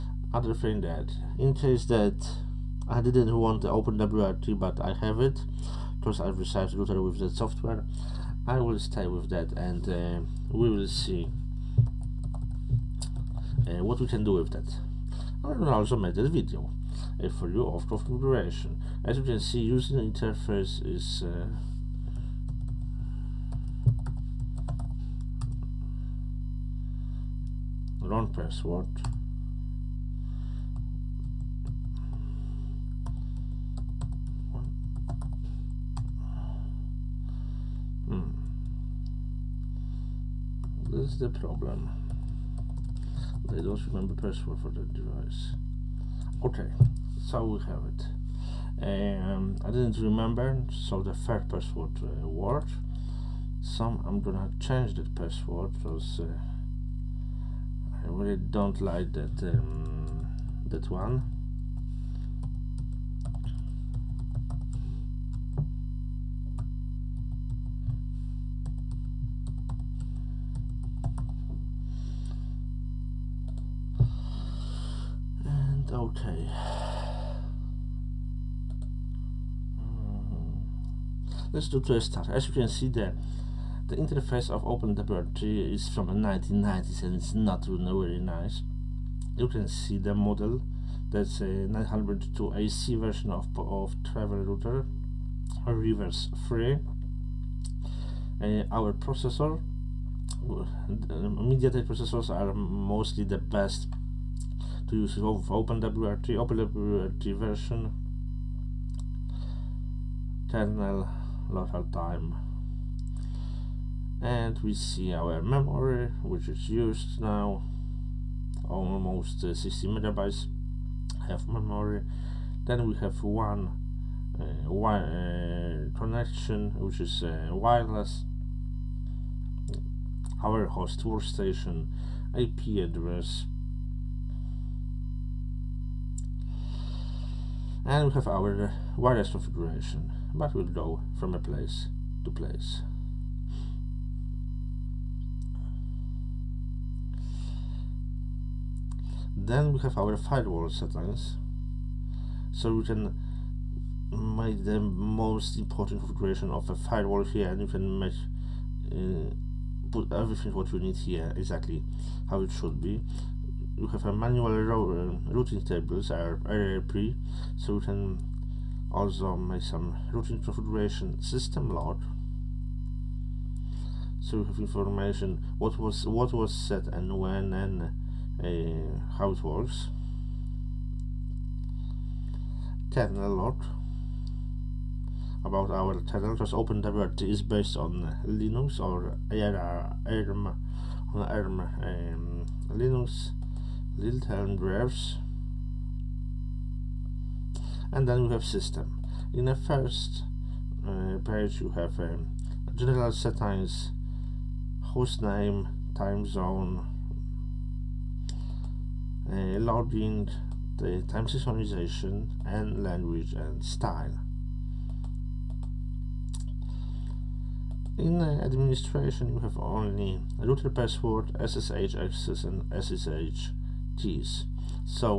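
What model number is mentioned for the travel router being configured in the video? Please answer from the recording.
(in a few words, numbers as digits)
902 AC.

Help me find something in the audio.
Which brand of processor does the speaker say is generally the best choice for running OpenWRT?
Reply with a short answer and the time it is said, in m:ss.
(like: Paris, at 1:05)
MediaTek, at 1:40.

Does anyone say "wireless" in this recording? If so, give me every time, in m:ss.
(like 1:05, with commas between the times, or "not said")
2:07, 2:18.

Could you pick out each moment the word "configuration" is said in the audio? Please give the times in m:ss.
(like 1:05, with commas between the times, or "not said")
0:17, 2:19, 2:36, 2:50.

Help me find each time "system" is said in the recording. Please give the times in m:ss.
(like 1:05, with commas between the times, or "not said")
2:51, 3:18.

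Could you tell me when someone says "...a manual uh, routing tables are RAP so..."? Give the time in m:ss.
2:44.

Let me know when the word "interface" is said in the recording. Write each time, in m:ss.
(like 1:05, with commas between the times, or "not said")
0:19, 1:23.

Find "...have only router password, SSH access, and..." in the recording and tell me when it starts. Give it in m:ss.
3:39.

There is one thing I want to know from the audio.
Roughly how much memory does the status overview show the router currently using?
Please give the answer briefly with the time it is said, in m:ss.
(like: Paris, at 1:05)
60 megabytes, at 1:59.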